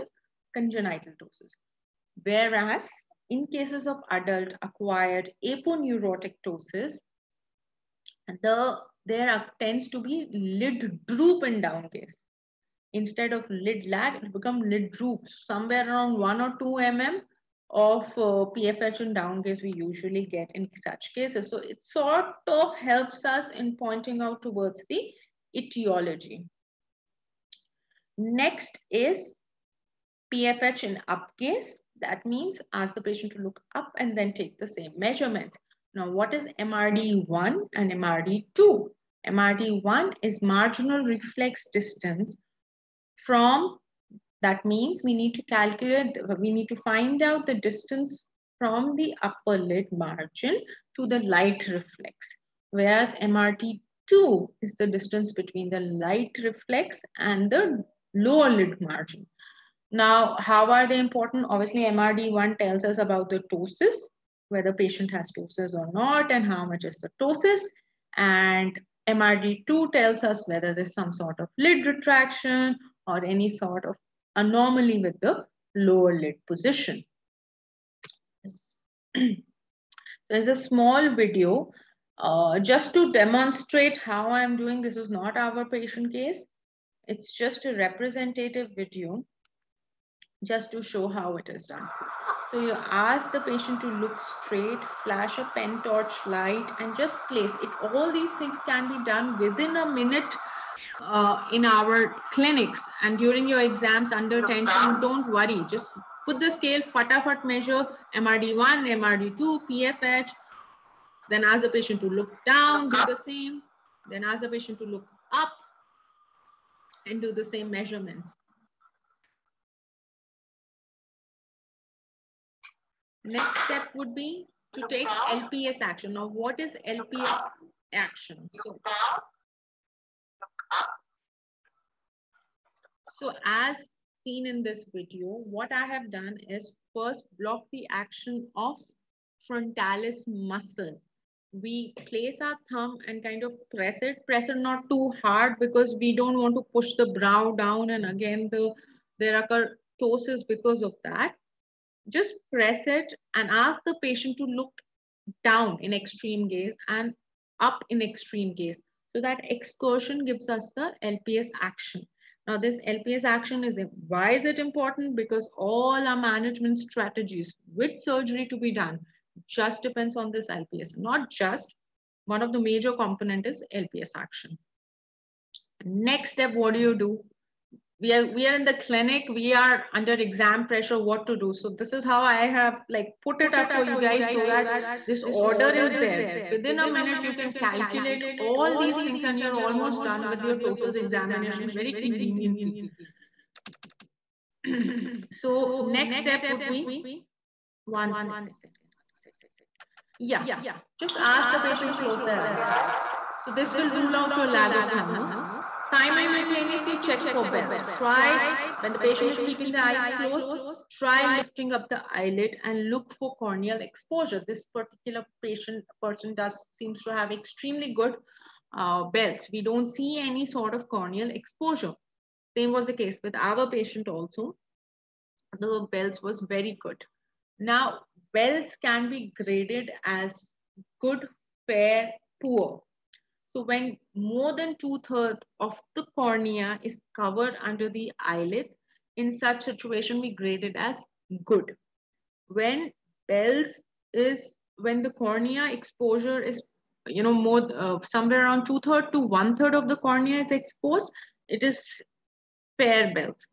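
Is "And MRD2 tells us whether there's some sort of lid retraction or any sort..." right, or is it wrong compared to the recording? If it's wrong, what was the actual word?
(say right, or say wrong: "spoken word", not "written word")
right.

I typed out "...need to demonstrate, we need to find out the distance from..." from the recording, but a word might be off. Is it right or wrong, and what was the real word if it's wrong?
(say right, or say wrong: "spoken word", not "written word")
wrong: "calculate", not "demonstrate".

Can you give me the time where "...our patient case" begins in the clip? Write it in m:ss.
1:25.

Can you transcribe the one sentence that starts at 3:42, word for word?
Same was the case with our patient also.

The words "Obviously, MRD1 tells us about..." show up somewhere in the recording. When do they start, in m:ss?
1:01.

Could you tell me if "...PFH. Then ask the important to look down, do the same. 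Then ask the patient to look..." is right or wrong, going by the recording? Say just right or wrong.
wrong.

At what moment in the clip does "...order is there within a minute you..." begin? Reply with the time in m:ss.
3:05.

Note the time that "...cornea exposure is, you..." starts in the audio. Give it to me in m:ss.
4:05.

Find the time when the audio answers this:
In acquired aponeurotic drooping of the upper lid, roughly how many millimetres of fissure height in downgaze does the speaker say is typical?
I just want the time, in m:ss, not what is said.
0:16.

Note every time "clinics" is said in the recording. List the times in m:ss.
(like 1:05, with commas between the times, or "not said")
1:42, 2:58.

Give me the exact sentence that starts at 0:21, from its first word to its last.
So it sort of helps us in pointing out towards the etiology.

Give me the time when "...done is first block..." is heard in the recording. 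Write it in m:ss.
2:16.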